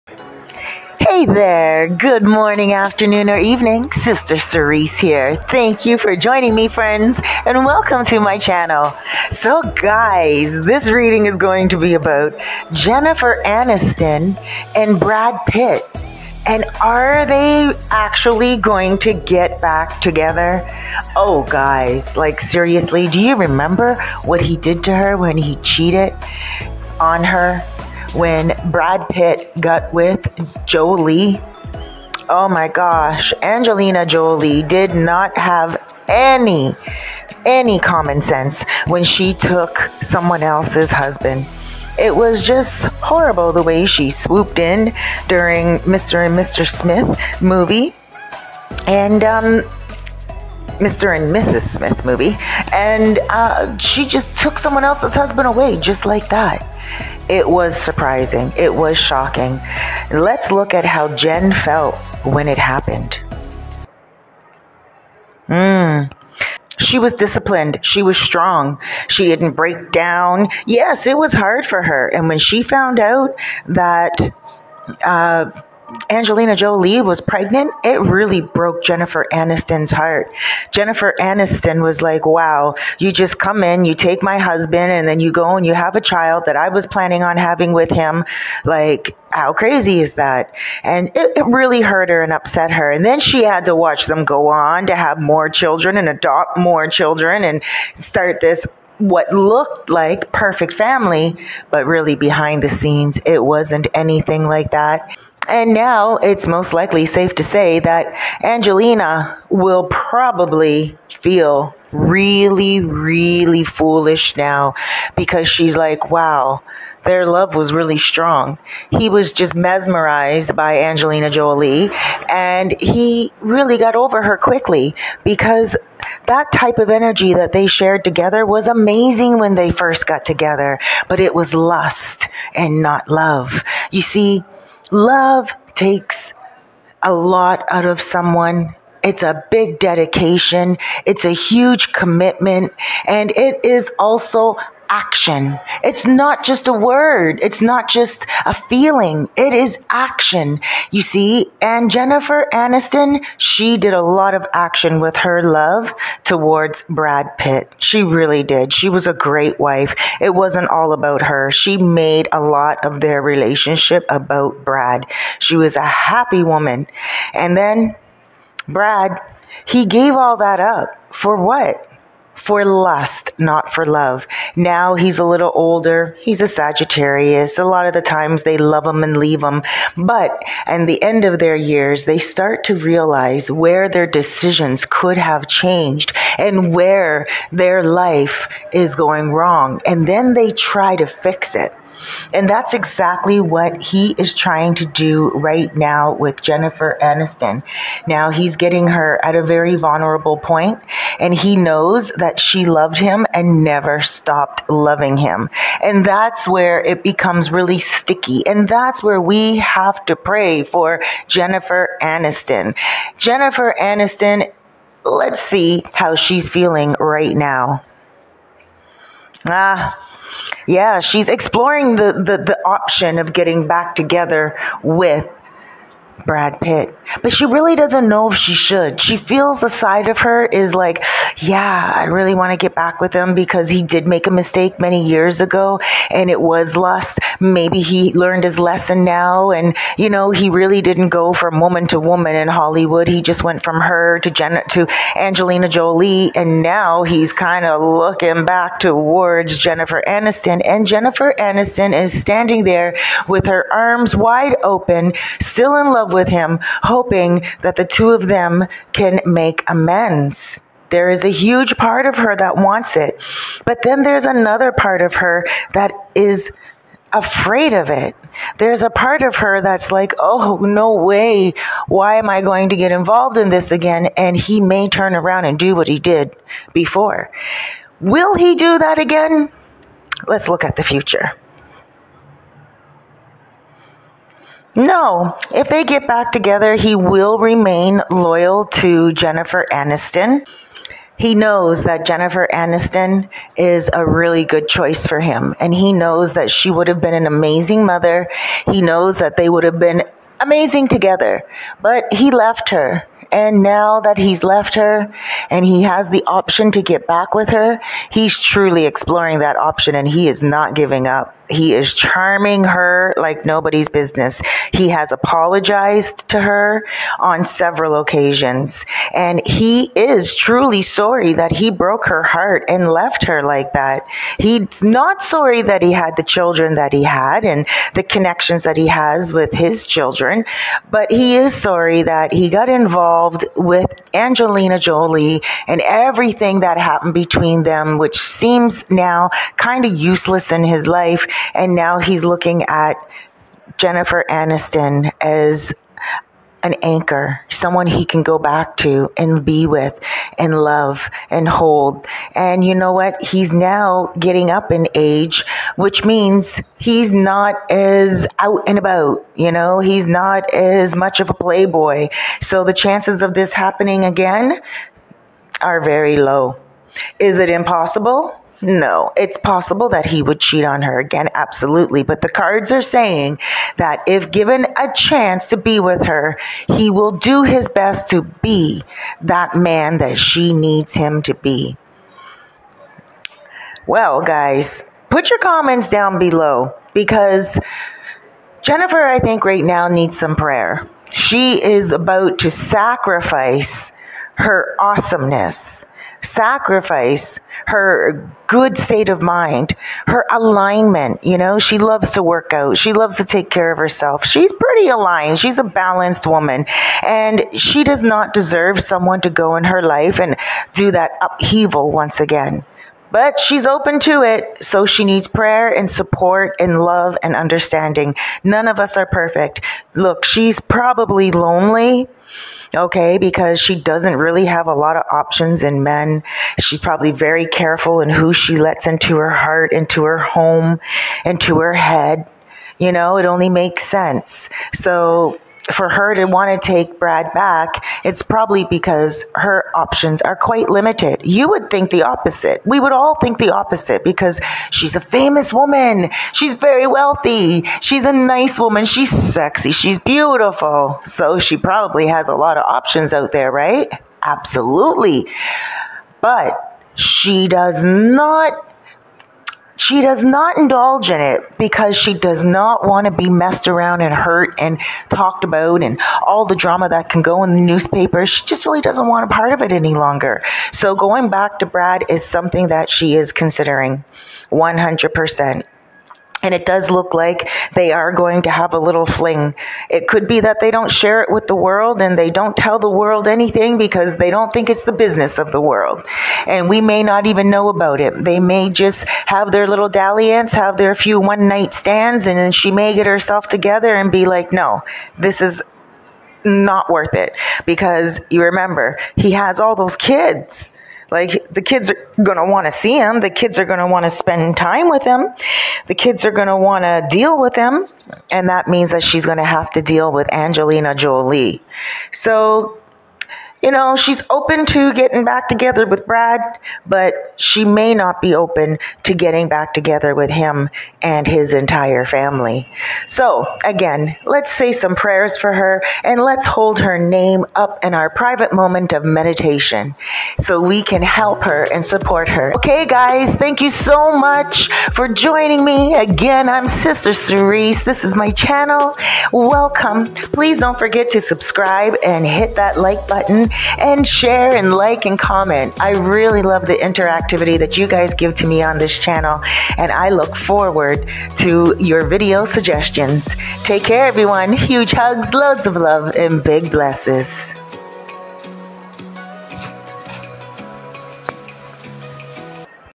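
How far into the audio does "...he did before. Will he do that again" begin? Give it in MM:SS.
04:35.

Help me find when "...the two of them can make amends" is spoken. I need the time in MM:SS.
04:17.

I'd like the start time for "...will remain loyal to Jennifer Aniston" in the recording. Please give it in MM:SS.
04:46.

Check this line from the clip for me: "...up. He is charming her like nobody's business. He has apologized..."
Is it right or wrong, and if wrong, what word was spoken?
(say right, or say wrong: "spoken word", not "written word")
right.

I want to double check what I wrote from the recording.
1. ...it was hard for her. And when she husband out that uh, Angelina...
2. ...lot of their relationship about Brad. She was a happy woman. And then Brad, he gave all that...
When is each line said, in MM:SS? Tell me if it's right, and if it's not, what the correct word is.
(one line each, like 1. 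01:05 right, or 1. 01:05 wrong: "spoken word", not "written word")
1. 01:11 wrong: "found", not "husband"
2. 02:42 right.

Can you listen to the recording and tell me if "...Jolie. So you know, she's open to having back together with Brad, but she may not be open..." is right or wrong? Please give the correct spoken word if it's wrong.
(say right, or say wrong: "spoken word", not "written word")
wrong: "getting", not "having".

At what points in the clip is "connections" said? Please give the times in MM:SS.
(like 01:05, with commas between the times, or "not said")
05:28.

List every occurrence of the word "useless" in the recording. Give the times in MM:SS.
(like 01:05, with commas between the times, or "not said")
05:39.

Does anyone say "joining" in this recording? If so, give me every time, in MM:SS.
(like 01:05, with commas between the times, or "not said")
00:06, 08:55.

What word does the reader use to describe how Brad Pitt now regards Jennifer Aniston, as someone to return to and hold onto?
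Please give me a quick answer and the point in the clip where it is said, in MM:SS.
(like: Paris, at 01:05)
Anchor, at 05:46.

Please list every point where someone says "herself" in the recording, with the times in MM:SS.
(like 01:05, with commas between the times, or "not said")
06:43, 08:13.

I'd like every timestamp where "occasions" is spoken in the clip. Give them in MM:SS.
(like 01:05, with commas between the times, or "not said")
05:17.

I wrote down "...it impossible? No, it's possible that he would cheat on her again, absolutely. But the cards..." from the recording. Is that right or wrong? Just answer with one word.
right.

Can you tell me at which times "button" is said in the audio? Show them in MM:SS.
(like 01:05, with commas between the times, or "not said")
09:03.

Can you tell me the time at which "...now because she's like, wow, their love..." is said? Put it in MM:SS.
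01:54.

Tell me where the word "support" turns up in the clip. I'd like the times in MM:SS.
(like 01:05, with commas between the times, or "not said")
06:55, 08:51.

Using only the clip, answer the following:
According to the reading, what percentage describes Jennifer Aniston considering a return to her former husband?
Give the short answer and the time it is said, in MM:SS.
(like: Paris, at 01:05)
100%, at 07:54.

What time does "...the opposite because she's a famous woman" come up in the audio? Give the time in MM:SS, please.
07:23.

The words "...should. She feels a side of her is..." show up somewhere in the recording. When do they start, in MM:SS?
03:48.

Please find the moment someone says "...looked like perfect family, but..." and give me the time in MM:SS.
01:39.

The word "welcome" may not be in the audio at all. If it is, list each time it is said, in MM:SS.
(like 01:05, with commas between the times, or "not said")
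00:07, 08:59.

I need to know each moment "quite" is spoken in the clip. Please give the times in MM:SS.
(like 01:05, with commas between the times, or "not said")
07:20.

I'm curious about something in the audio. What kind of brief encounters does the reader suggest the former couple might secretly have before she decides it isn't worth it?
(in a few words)
One night stands.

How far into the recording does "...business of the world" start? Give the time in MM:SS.
08:04.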